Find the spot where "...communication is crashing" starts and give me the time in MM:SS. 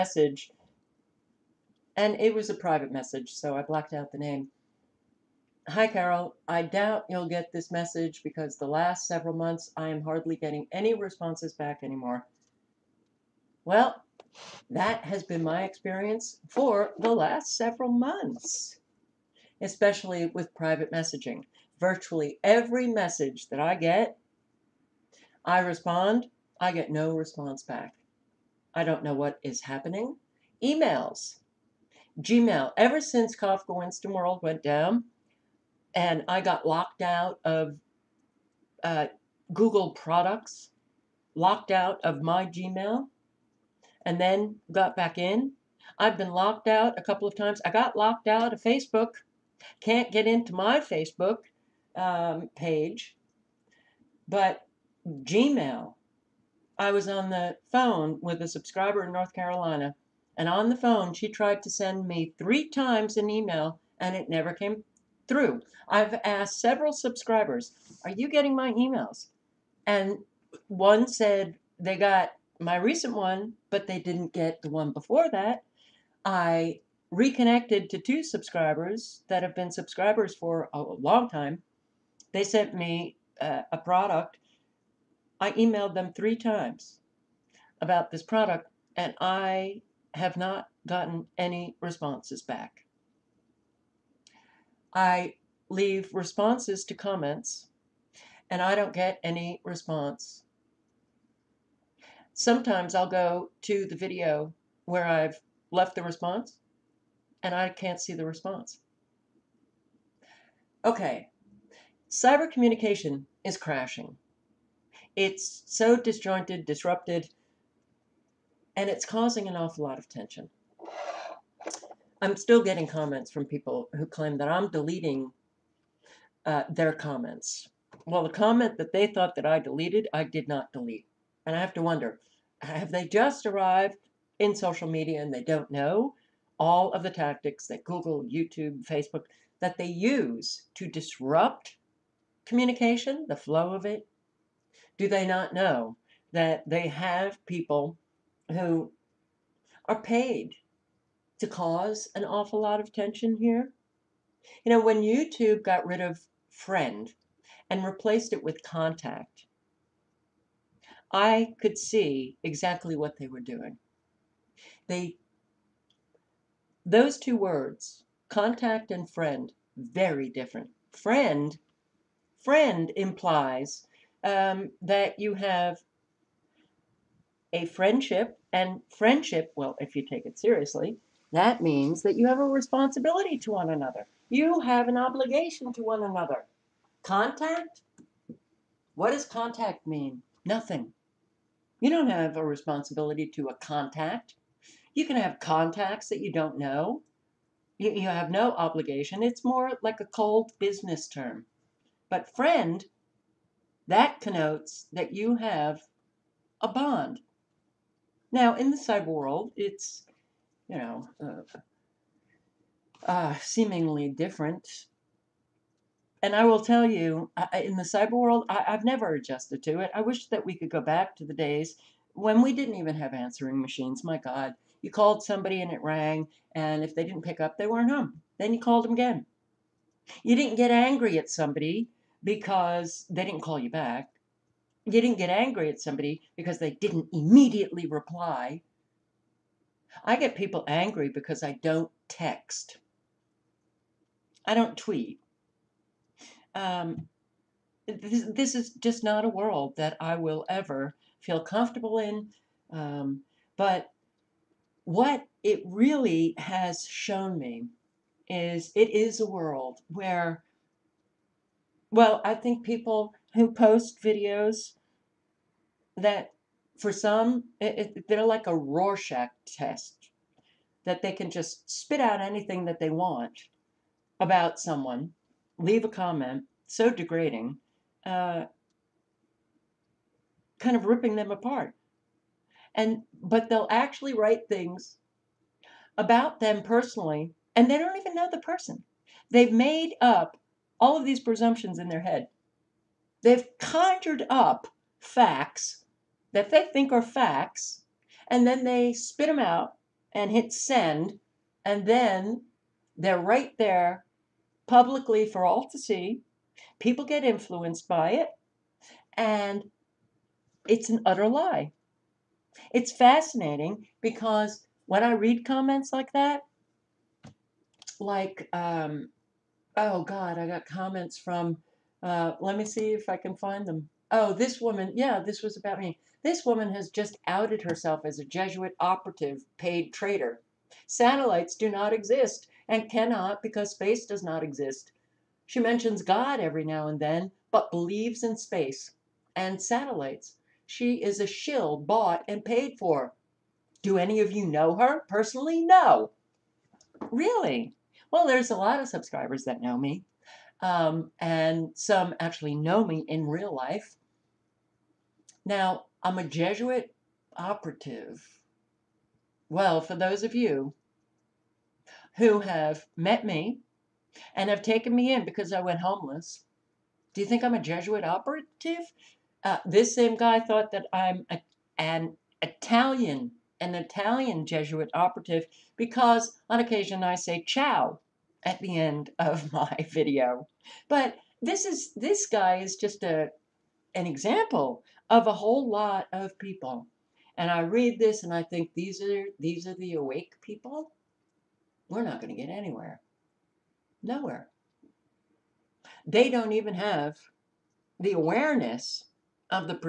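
01:52.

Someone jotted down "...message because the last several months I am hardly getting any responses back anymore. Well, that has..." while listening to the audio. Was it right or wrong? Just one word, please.
right.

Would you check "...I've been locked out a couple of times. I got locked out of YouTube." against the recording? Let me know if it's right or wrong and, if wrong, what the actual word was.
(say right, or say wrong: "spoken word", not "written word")
wrong: "Facebook", not "YouTube".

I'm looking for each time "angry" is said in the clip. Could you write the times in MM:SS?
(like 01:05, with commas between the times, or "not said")
03:50, 03:55, 04:00.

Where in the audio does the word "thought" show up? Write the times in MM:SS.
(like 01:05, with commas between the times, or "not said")
02:09, 06:10.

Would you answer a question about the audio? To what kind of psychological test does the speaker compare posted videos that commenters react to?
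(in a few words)
Rorschach test.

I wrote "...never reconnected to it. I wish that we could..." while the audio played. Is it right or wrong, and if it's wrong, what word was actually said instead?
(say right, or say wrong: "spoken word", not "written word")
wrong: "adjusted", not "reconnected".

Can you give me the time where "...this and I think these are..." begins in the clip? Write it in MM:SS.
06:27.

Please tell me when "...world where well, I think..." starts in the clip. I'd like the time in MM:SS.
04:19.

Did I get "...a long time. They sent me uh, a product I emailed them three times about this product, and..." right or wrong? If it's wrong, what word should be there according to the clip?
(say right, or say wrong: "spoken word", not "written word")
right.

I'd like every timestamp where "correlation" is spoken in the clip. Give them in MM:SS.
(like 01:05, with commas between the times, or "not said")
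not said.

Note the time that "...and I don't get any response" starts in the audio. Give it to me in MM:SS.
01:38.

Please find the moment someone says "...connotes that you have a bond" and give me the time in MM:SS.
03:24.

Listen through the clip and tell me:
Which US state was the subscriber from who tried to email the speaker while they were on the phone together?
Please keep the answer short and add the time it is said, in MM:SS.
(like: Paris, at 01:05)
North Carolina, at 00:59.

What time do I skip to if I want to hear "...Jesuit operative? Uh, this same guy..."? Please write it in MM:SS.
06:07.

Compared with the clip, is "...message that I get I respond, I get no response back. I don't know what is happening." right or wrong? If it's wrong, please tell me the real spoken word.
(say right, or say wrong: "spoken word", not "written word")
right.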